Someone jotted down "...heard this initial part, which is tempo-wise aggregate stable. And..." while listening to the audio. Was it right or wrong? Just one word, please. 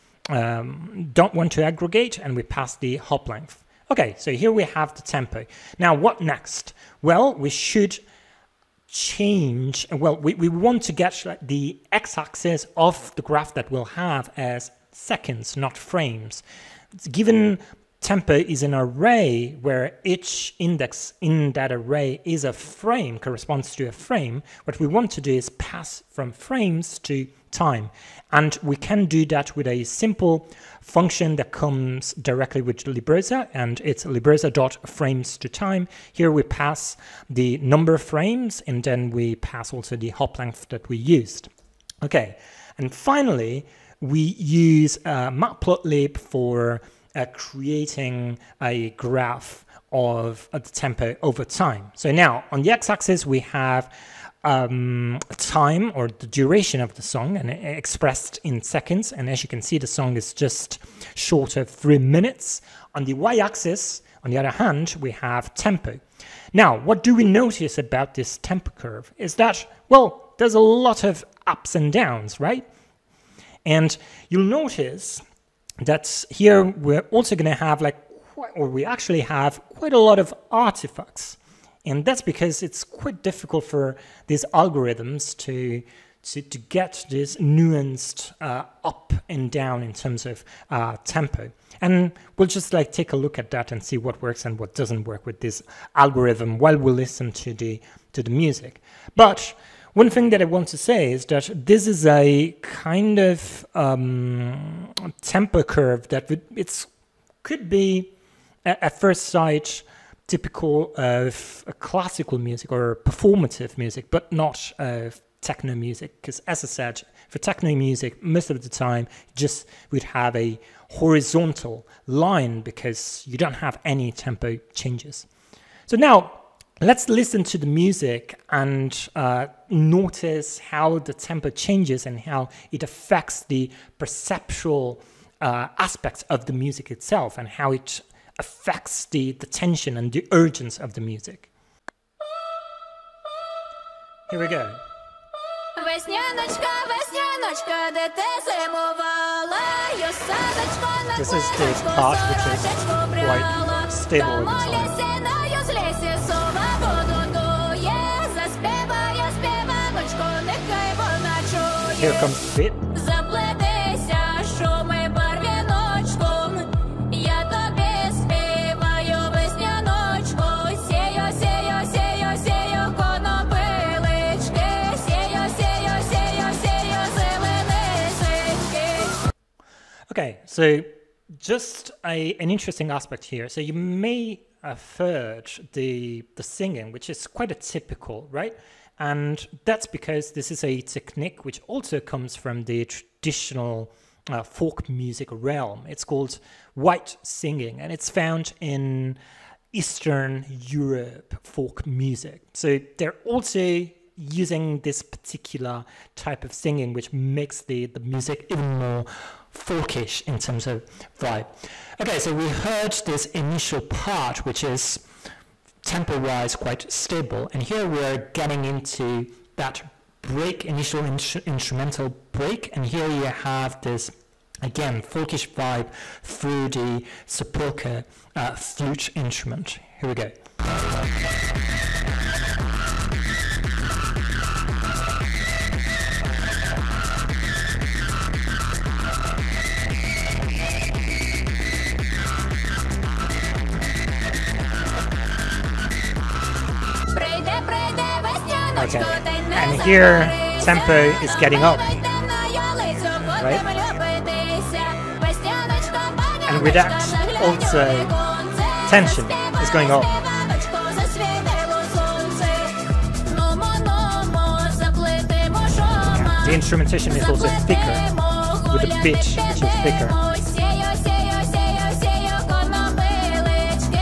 wrong.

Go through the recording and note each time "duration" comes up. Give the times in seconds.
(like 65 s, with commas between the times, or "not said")
56 s.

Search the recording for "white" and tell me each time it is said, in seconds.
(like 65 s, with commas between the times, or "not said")
196 s.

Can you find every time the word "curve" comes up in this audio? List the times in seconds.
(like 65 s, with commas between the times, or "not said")
68 s, 105 s.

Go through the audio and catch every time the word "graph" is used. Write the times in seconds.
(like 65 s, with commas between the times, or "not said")
13 s, 48 s.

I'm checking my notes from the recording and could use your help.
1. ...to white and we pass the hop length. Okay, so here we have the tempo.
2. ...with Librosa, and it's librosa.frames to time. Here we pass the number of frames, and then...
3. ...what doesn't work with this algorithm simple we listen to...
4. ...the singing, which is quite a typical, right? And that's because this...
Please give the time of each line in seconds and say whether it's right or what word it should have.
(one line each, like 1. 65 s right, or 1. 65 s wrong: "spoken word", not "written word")
1. 1 s wrong: "aggregate", not "white"
2. 32 s right
3. 94 s wrong: "while", not "simple"
4. 186 s right.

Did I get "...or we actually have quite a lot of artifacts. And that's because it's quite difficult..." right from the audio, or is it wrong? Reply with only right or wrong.
right.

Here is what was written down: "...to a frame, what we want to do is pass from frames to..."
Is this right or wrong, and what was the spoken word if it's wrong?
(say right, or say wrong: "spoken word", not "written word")
right.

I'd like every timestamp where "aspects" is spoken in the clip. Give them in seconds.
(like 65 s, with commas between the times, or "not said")
135 s, 182 s.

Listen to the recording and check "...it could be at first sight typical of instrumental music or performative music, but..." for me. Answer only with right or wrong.
wrong.